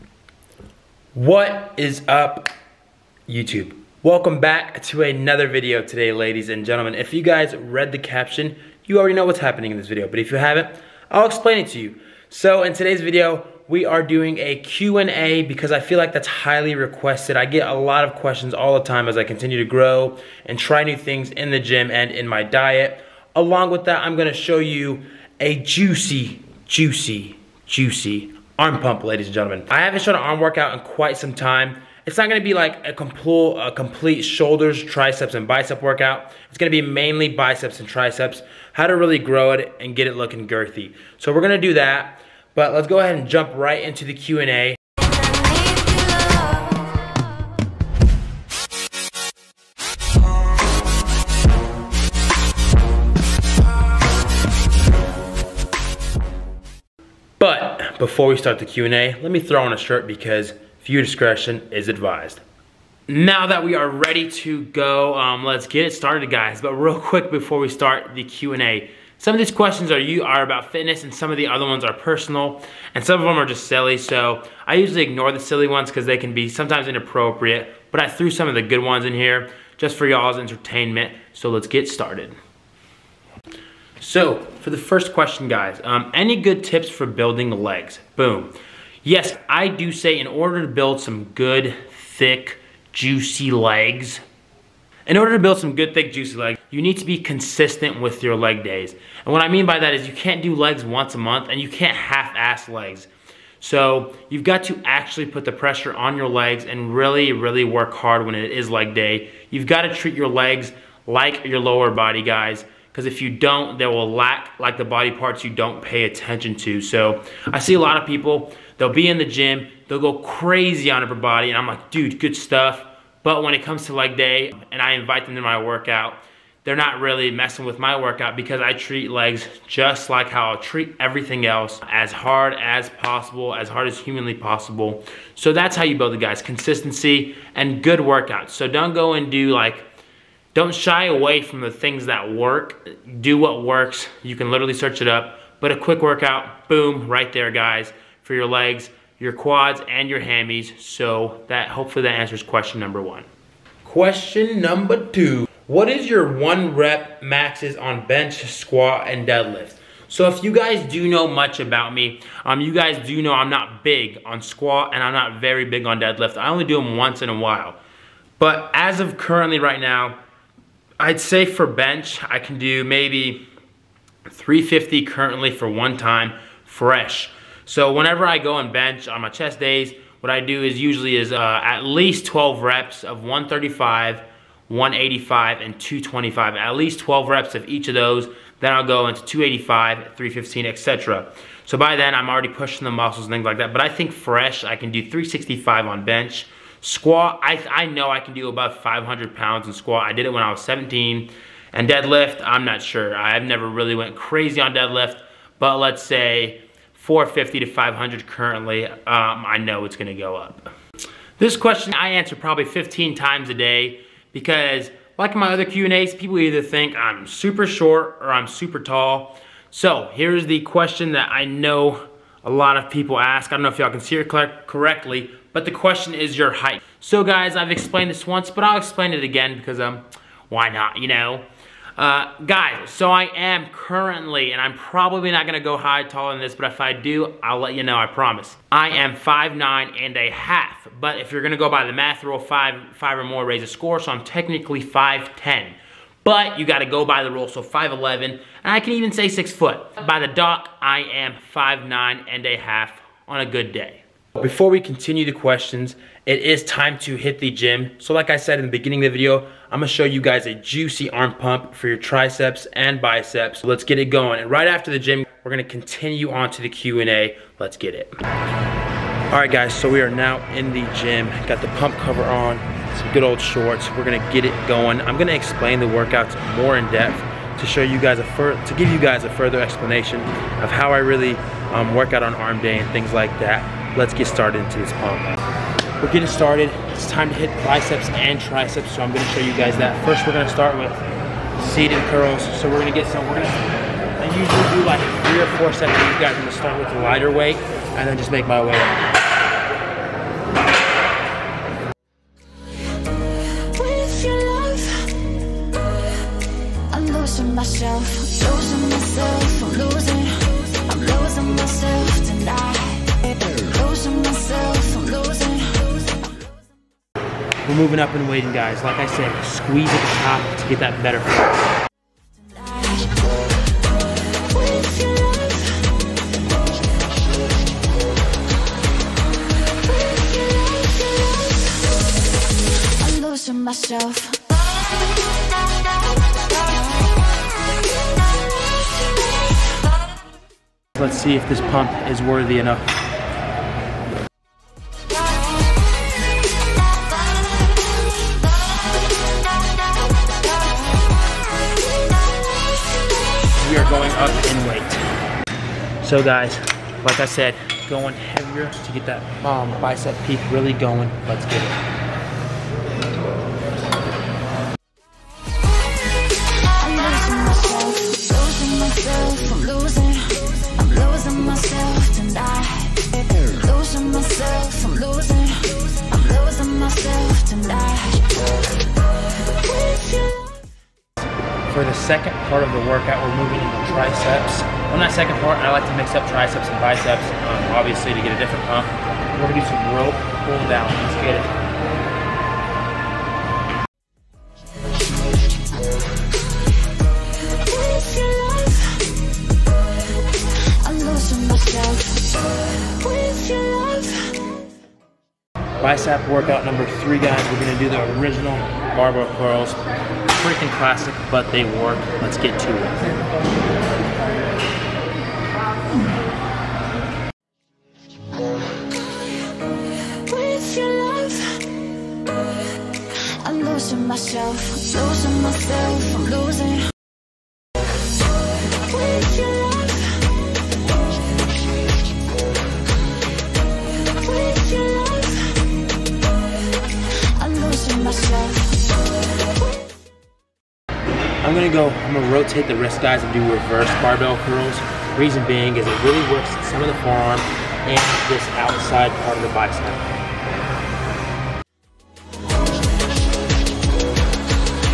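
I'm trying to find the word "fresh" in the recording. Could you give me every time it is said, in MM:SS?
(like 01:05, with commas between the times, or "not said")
02:56, 03:14.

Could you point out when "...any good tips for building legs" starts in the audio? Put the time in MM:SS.
01:26.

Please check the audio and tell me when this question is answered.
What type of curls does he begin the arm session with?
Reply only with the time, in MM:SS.
04:51.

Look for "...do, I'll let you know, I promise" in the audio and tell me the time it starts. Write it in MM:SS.
03:56.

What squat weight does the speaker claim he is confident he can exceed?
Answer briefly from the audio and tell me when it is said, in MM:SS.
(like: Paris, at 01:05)
500 pounds, at 03:18.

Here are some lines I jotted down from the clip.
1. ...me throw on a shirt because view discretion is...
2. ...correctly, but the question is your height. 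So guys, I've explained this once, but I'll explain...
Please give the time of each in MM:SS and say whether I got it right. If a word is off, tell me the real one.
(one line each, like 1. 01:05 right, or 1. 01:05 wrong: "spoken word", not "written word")
1. 00:59 right
2. 03:44 right.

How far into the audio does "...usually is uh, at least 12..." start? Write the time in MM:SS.
03:00.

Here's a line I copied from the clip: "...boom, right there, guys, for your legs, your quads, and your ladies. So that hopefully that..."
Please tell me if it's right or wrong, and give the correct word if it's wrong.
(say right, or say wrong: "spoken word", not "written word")
wrong: "hammies", not "ladies".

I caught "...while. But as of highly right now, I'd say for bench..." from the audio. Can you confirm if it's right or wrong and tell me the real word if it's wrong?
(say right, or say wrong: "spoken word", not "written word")
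wrong: "currently", not "highly".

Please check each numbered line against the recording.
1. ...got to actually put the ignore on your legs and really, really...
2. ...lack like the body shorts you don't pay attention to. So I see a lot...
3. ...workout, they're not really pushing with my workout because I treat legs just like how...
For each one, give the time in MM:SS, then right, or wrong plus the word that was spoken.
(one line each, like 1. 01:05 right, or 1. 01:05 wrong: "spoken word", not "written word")
1. 01:44 wrong: "pressure", not "ignore"
2. 01:54 wrong: "parts", not "shorts"
3. 02:05 wrong: "messing", not "pushing".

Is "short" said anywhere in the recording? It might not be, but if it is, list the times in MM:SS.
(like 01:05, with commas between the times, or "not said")
03:37, 04:33.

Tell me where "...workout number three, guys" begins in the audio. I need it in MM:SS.
06:46.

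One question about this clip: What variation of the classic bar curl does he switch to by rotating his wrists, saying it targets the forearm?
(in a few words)
reverse barbell curls.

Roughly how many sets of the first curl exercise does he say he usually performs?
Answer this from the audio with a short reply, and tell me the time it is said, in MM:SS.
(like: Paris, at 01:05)
three or four, at 04:55.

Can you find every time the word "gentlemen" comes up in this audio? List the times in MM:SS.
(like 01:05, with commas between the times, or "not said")
00:06, 00:29.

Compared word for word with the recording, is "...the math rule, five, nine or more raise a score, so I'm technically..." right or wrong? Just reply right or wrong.
wrong.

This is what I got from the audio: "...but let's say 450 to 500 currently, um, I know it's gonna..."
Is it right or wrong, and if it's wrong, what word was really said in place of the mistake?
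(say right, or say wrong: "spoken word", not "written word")
right.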